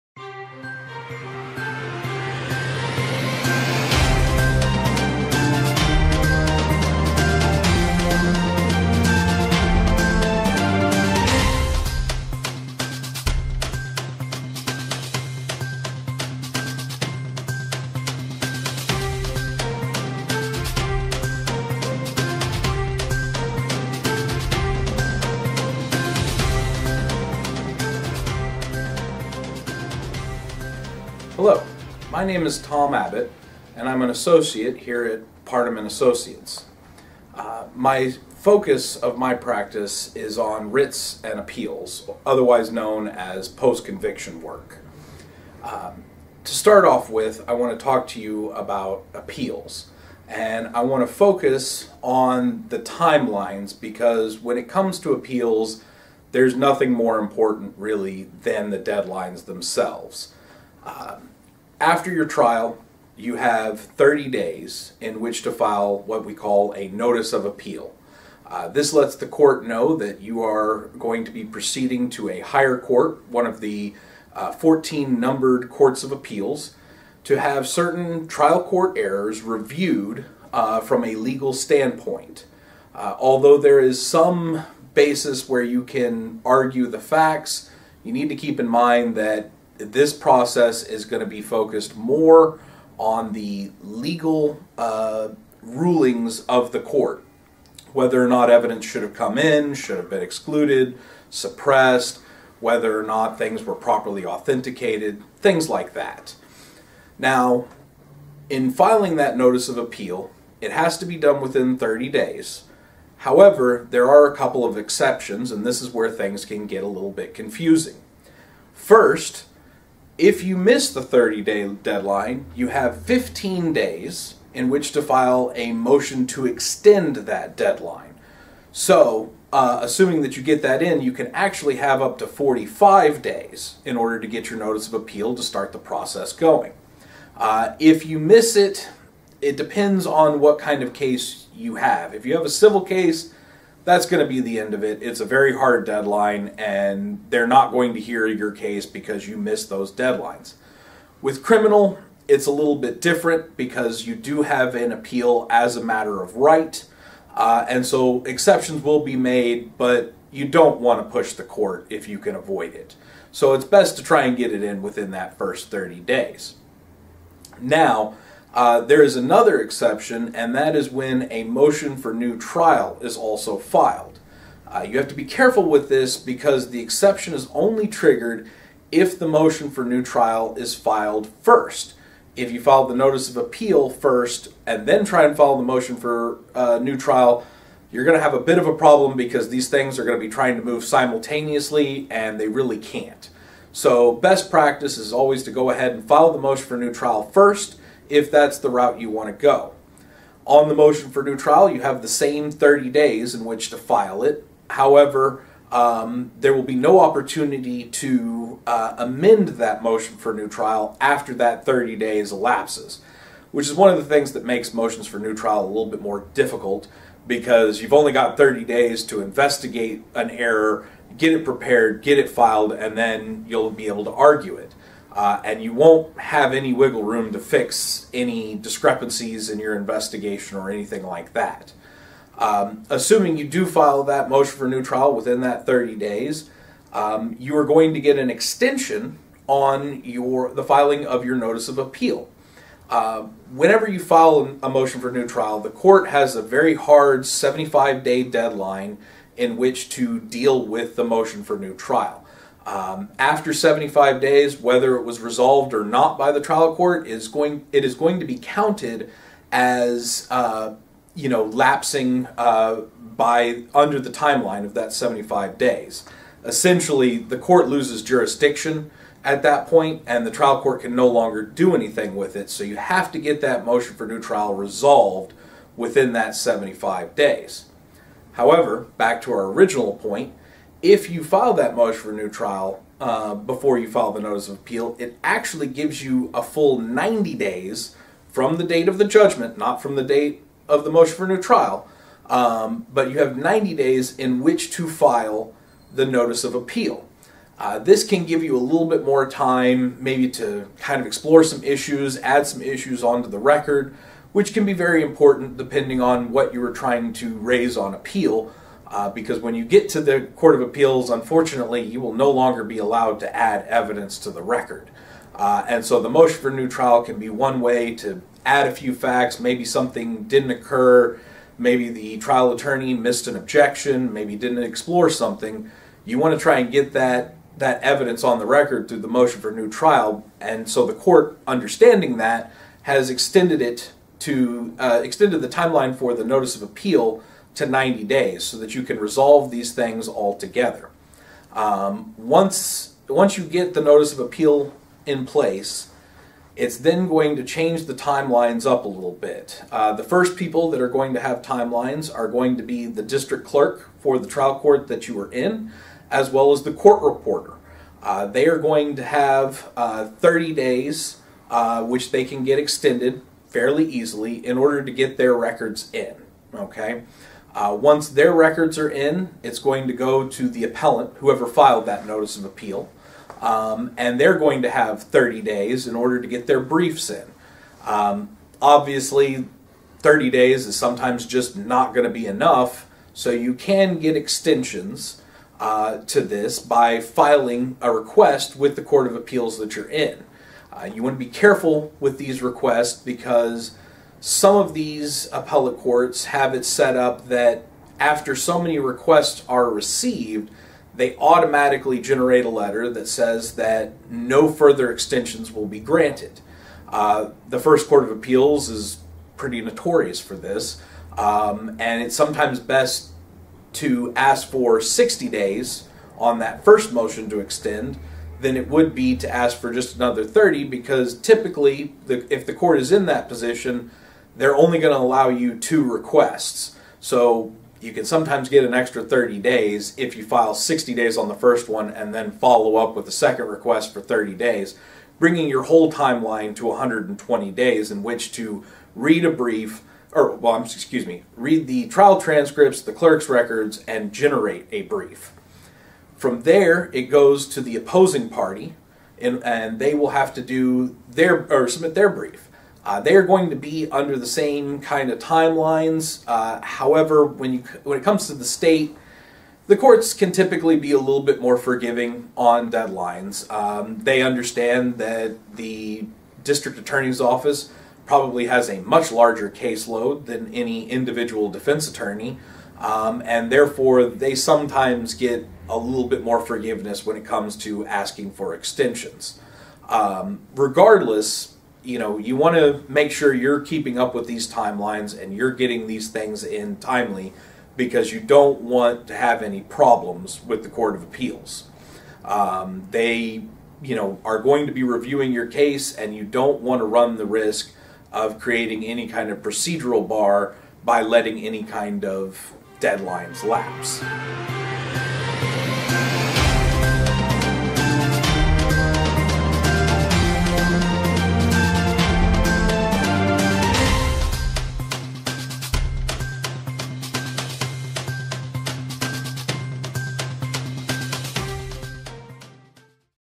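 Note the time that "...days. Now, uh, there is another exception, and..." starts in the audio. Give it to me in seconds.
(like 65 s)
166 s.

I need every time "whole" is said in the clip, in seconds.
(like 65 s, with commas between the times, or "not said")
435 s.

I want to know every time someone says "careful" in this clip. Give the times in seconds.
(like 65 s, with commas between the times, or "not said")
175 s, 391 s.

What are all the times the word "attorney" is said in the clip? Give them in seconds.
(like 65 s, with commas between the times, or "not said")
322 s, 466 s, 471 s.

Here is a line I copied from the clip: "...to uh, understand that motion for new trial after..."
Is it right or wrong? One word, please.
wrong.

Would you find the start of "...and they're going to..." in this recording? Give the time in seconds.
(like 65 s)
373 s.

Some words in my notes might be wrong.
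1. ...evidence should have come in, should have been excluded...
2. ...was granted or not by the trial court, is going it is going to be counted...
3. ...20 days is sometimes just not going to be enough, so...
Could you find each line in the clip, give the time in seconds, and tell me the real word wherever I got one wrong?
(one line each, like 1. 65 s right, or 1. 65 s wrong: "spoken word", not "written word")
1. 98 s right
2. 255 s wrong: "resolved", not "granted"
3. 379 s wrong: "30", not "20".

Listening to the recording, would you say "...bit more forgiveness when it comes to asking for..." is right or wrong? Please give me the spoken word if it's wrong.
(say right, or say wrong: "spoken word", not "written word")
right.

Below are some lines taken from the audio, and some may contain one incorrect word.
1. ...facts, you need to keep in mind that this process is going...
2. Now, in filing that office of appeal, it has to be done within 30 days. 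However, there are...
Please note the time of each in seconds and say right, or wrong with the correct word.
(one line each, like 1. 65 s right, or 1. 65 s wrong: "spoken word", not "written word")
1. 86 s right
2. 107 s wrong: "notice", not "office".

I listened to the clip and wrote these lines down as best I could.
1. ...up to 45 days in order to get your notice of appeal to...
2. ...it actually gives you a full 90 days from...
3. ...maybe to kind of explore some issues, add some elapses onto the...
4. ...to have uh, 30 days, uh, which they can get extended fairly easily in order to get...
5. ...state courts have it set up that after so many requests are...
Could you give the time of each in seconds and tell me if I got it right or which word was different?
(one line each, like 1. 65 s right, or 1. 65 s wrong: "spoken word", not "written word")
1. 132 s right
2. 284 s right
3. 300 s wrong: "issues", not "elapses"
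4. 358 s right
5. 395 s wrong: "appellate", not "state".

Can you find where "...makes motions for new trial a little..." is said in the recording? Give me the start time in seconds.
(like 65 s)
214 s.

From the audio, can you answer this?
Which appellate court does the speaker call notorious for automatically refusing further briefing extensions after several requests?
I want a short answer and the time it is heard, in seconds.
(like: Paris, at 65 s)
First Court of Appeals, at 407 s.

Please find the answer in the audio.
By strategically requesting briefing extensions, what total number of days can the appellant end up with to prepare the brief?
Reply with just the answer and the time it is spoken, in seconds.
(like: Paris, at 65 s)
120, at 436 s.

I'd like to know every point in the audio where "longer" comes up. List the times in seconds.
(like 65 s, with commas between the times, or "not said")
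271 s, 312 s.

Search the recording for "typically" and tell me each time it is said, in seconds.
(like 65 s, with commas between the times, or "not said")
421 s, 460 s.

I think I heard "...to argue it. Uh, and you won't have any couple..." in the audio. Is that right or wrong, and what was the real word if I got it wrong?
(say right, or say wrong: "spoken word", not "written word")
wrong: "wiggle", not "couple".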